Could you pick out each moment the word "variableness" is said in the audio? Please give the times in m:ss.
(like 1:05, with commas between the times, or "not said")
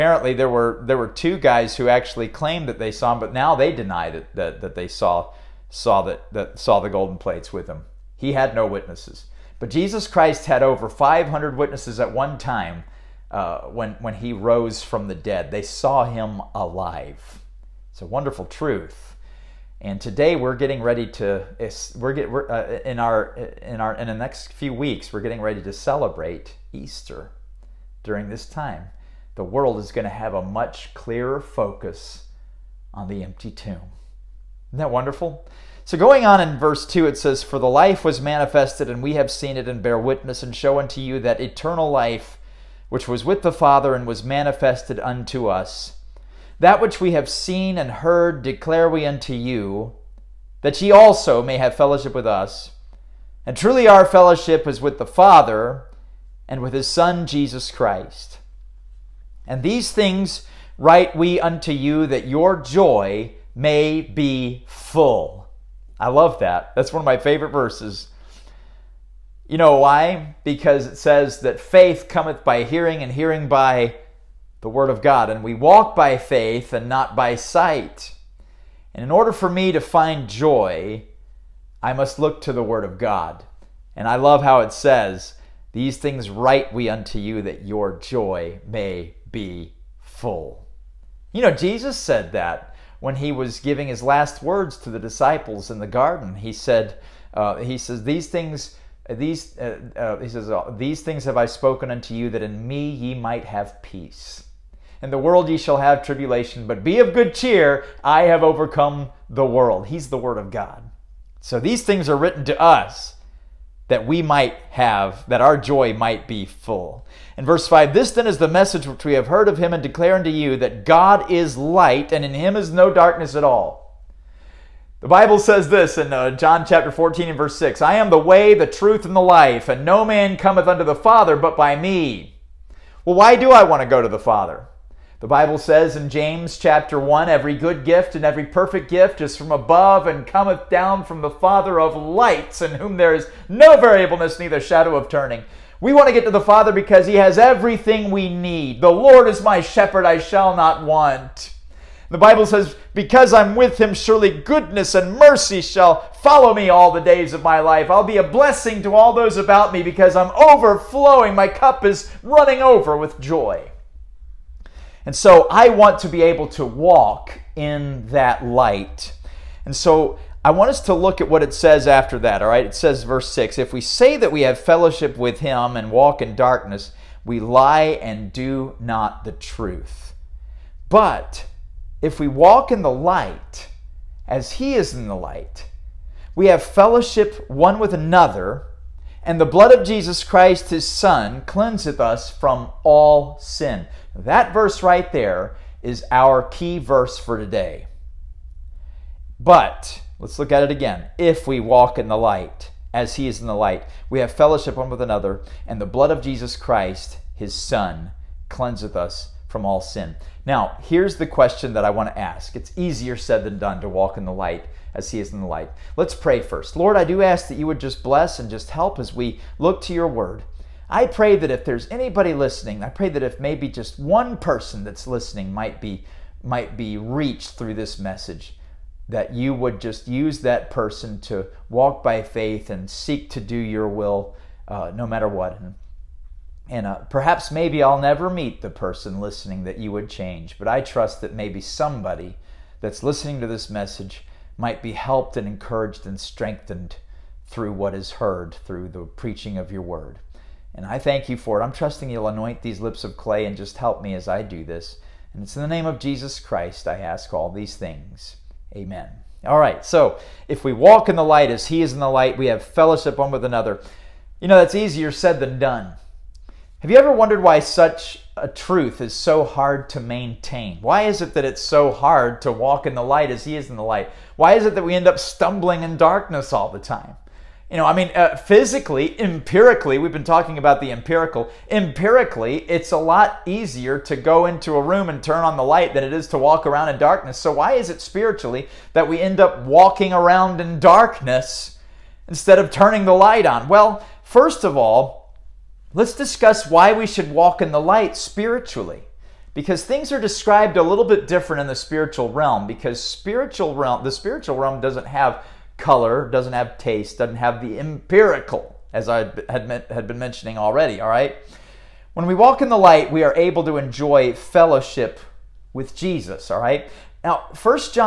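2:23.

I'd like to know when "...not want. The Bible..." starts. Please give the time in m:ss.
2:30.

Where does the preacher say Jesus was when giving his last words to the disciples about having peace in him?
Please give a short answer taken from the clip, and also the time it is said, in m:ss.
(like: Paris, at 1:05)
the garden, at 1:35.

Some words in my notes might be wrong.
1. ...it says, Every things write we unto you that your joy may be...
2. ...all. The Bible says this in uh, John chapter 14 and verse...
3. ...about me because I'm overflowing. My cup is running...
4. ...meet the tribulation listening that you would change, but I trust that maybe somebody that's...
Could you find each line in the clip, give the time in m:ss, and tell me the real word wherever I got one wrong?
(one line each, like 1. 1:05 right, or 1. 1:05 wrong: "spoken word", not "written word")
1. 1:24 wrong: "These", not "Every"
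2. 2:03 right
3. 2:39 right
4. 3:58 wrong: "person", not "tribulation".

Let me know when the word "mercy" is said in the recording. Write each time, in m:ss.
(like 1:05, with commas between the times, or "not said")
2:35.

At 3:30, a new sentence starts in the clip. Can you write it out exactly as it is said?
Now, here's the question that I want to ask.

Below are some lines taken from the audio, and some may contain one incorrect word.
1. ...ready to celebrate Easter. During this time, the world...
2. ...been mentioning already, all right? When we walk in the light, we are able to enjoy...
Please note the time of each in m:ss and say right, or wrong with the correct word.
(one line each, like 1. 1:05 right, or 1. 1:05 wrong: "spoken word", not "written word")
1. 0:25 right
2. 5:10 right.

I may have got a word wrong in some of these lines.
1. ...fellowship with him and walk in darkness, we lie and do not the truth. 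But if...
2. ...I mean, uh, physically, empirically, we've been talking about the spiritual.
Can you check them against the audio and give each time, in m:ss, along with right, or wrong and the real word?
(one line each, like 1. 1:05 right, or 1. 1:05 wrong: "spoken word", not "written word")
1. 2:54 right
2. 4:37 wrong: "empirical", not "spiritual".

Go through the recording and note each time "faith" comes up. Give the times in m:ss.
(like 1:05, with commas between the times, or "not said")
1:11, 1:16, 3:52.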